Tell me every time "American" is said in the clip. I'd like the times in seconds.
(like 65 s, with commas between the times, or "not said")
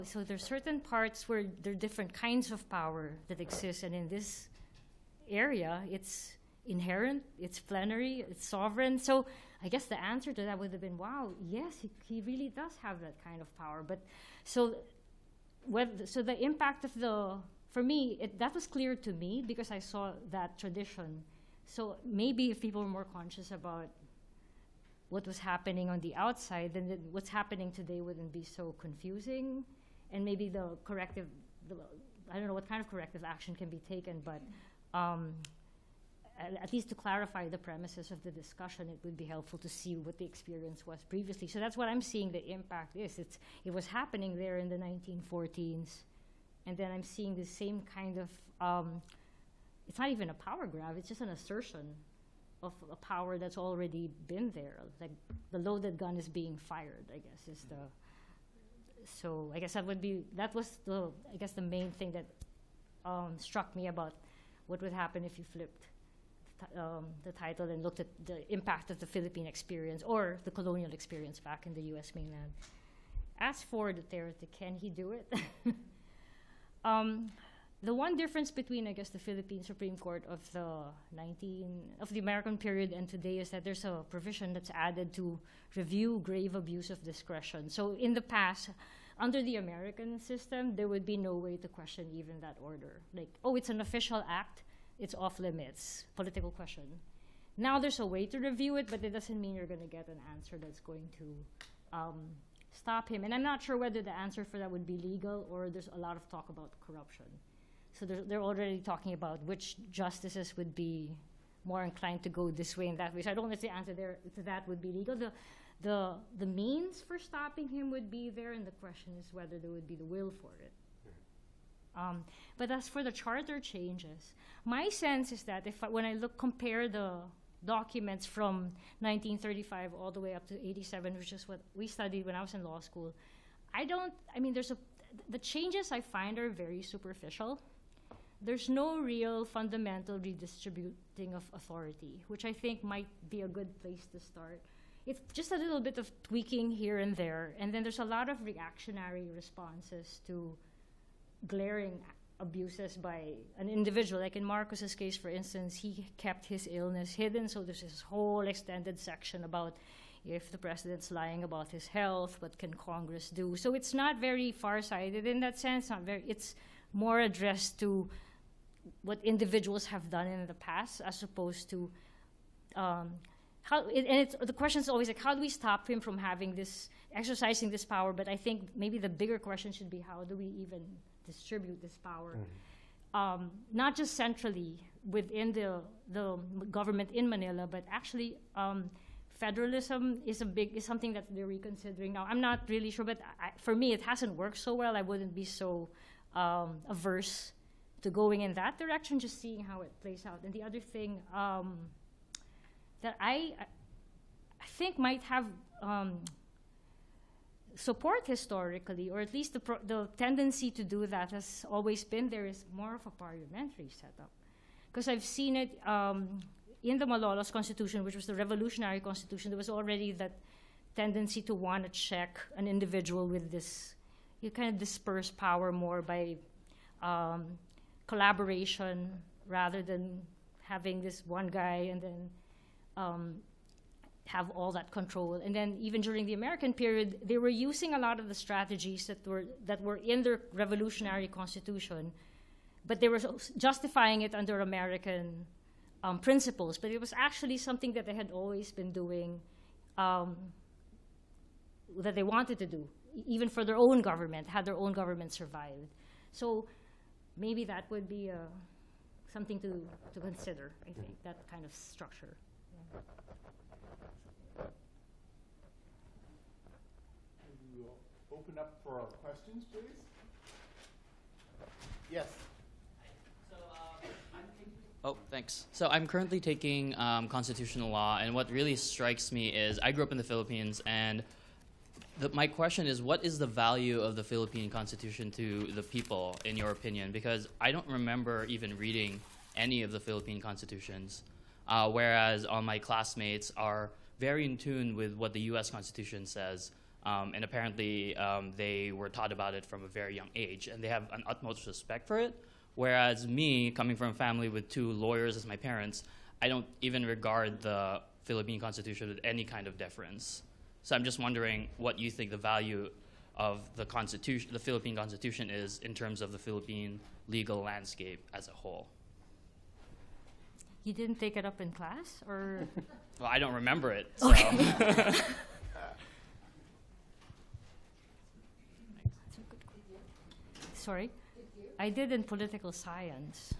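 82 s, 89 s, 236 s, 244 s.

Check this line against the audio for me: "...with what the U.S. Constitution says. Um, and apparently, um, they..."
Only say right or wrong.
right.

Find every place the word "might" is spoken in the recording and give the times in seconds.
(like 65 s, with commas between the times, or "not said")
142 s, 204 s.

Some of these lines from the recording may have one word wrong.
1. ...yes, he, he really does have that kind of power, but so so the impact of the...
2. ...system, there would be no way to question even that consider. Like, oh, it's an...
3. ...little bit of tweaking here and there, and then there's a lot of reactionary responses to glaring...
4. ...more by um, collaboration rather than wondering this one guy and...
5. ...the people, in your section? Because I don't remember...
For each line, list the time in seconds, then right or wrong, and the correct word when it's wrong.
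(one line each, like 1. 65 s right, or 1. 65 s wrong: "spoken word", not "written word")
1. 11 s right
2. 90 s wrong: "order", not "consider"
3. 145 s right
4. 225 s wrong: "having", not "wondering"
5. 285 s wrong: "opinion", not "section".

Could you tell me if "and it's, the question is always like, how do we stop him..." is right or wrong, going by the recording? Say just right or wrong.
right.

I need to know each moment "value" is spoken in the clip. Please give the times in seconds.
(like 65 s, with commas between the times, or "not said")
283 s, 312 s.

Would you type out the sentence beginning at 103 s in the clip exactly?
And I'm not sure whether the answer for that would be legal or there's a lot of talk about corruption.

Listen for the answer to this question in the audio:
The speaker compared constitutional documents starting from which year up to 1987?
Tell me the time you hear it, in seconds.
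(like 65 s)
129 s.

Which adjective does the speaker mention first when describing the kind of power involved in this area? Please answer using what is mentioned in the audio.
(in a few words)
inherent.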